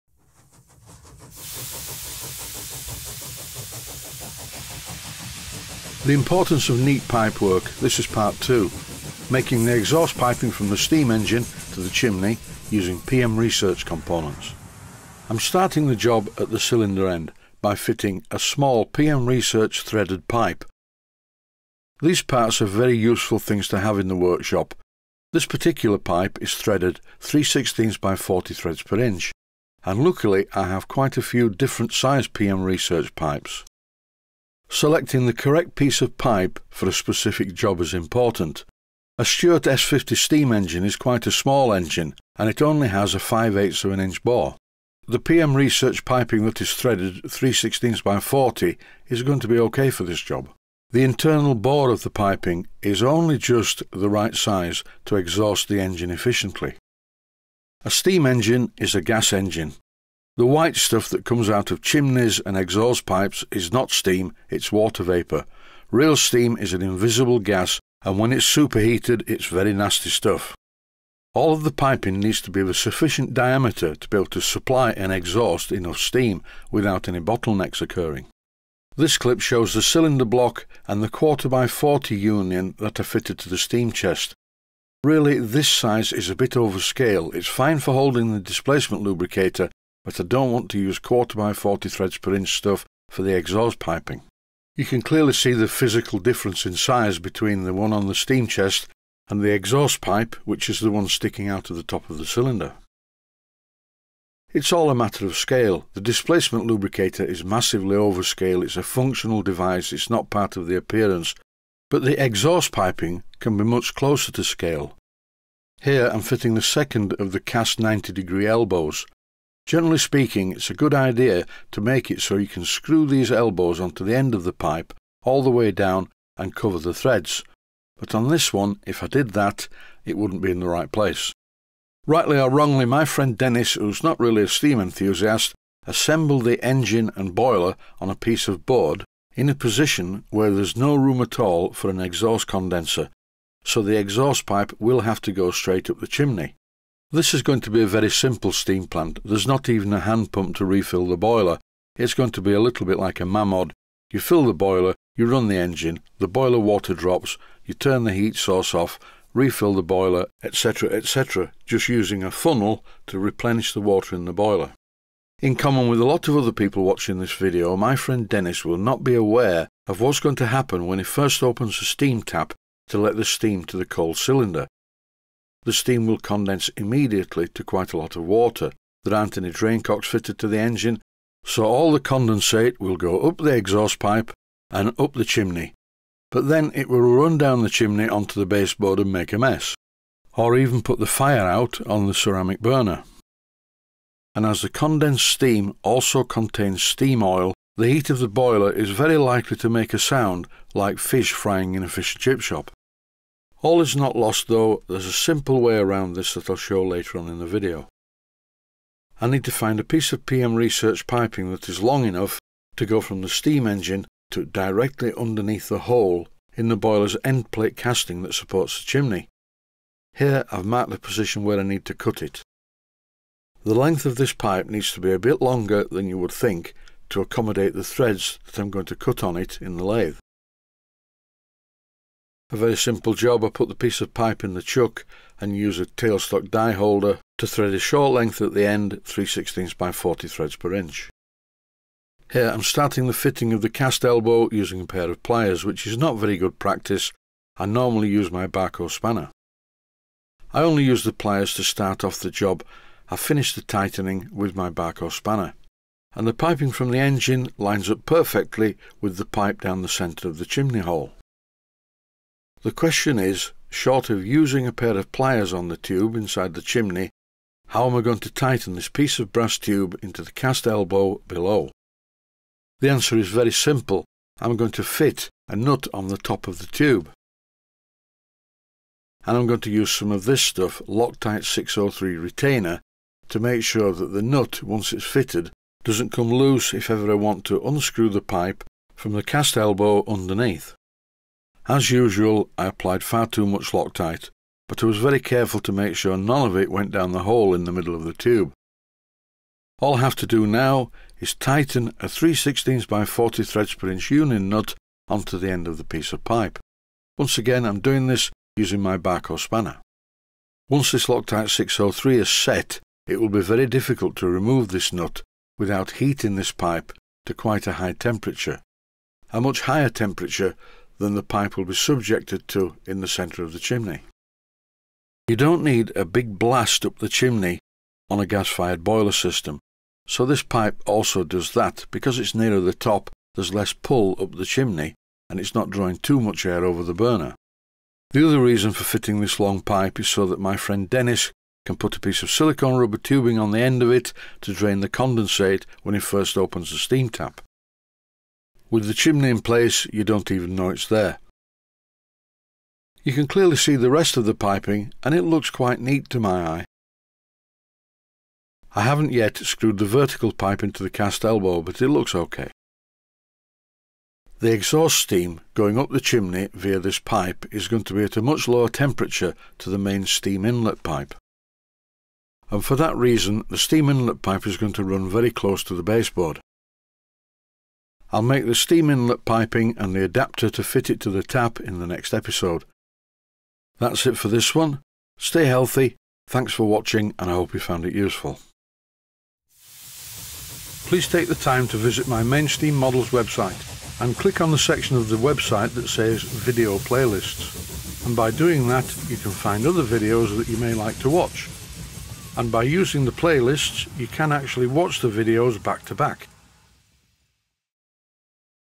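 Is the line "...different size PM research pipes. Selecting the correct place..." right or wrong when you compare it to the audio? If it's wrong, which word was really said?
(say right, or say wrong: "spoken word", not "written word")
wrong: "piece", not "place".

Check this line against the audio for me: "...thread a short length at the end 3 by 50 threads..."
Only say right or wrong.
wrong.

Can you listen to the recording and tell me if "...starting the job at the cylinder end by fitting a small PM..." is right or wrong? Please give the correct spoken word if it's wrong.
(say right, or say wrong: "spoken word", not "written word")
right.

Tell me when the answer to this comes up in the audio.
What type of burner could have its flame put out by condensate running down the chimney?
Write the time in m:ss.
3:12.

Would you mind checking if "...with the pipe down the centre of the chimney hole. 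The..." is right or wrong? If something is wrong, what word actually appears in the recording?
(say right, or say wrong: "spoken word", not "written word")
right.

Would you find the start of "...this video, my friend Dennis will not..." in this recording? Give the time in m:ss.
2:47.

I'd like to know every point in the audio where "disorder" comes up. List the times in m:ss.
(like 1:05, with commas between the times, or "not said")
not said.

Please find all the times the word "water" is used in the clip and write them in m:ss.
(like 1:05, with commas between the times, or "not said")
1:04, 2:36, 2:43, 2:58.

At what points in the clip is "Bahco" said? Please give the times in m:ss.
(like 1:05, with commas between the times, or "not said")
4:08, 4:14, 5:08.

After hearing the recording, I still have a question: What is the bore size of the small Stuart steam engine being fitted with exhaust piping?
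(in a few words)
5/8 of an inch.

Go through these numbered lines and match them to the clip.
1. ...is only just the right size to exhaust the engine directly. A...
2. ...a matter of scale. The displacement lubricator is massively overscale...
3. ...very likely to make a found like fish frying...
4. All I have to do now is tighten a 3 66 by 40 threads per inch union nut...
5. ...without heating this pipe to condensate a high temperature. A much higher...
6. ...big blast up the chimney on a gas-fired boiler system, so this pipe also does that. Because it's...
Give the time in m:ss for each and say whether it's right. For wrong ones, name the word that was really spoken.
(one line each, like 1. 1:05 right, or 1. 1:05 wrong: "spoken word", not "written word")
1. 0:52 wrong: "efficiently", not "directly"
2. 1:44 right
3. 3:18 wrong: "sound", not "found"
4. 4:59 wrong: "16", not "66"
5. 5:15 wrong: "quite", not "condensate"
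6. 5:26 right.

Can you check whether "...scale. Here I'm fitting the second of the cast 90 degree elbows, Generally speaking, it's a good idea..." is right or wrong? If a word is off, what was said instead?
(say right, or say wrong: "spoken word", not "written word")
right.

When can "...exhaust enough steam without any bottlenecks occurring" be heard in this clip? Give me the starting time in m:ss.
1:15.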